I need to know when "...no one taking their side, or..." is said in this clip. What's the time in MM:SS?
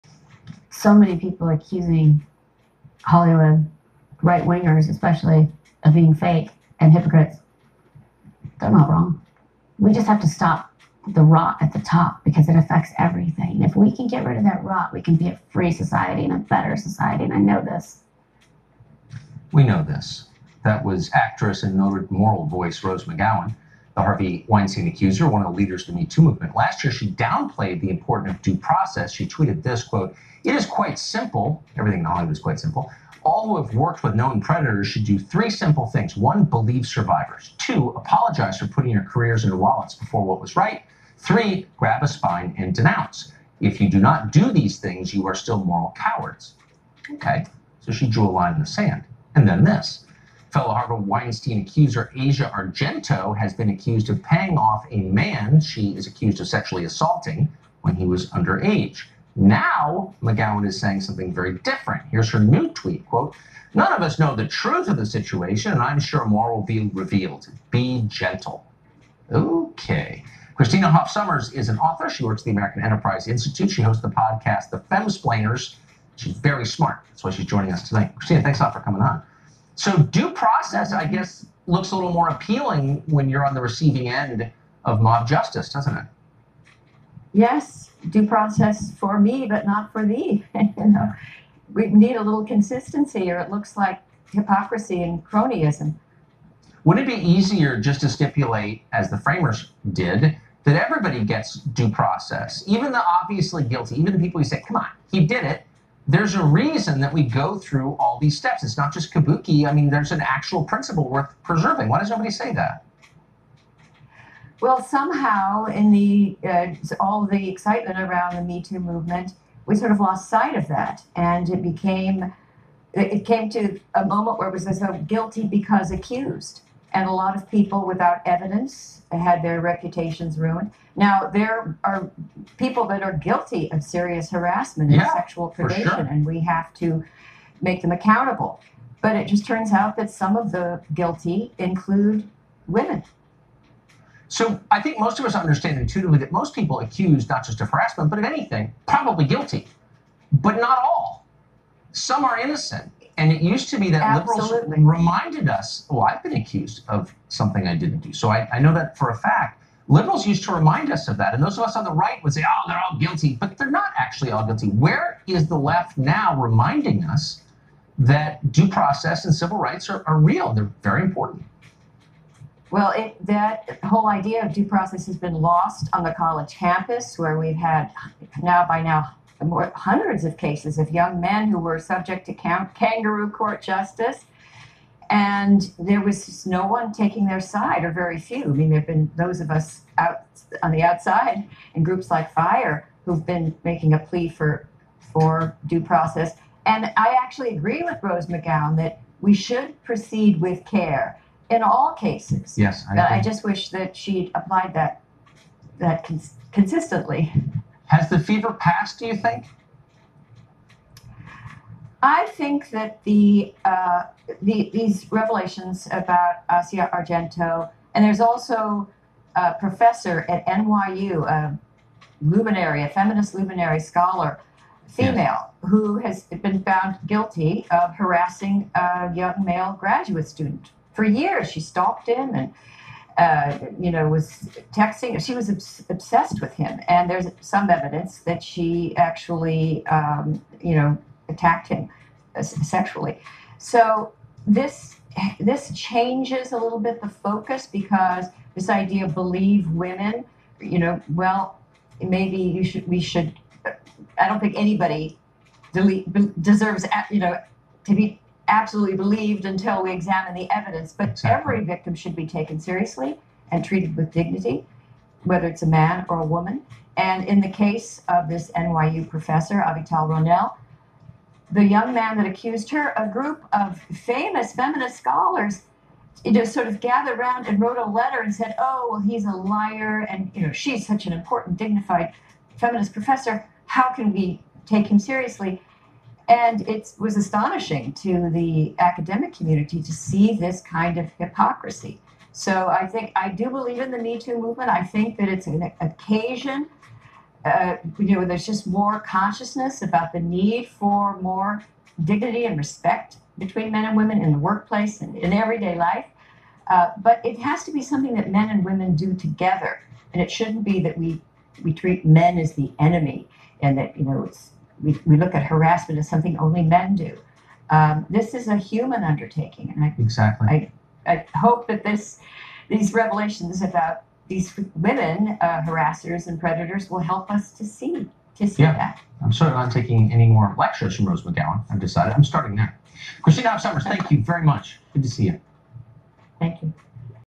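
03:06.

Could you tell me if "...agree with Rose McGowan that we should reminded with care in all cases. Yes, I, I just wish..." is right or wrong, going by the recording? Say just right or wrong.
wrong.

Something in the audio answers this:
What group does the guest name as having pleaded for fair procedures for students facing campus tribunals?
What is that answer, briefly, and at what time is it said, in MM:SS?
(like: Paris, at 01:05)
FIRE, at 03:12.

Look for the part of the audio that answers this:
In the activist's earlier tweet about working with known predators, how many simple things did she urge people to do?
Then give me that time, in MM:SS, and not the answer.
00:35.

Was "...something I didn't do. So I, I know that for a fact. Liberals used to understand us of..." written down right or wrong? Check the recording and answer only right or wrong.
wrong.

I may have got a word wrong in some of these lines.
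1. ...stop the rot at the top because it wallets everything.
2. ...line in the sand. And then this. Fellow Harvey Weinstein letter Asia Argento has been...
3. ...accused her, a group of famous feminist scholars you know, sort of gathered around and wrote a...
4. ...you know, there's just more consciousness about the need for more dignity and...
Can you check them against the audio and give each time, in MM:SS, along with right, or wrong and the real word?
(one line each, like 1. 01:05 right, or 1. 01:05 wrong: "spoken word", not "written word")
1. 00:10 wrong: "affects", not "wallets"
2. 00:48 wrong: "accuser", not "letter"
3. 04:32 right
4. 04:57 right.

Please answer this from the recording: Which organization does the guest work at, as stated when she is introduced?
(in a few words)
American Enterprise Institute.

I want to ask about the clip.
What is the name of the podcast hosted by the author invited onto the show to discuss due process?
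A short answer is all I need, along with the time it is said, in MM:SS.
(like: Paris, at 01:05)
The Femsplainers, at 01:14.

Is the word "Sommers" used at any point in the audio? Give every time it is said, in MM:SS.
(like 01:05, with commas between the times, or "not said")
01:11, 05:33.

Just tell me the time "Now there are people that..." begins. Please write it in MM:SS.
02:10.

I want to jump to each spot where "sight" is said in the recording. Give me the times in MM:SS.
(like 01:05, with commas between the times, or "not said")
02:00.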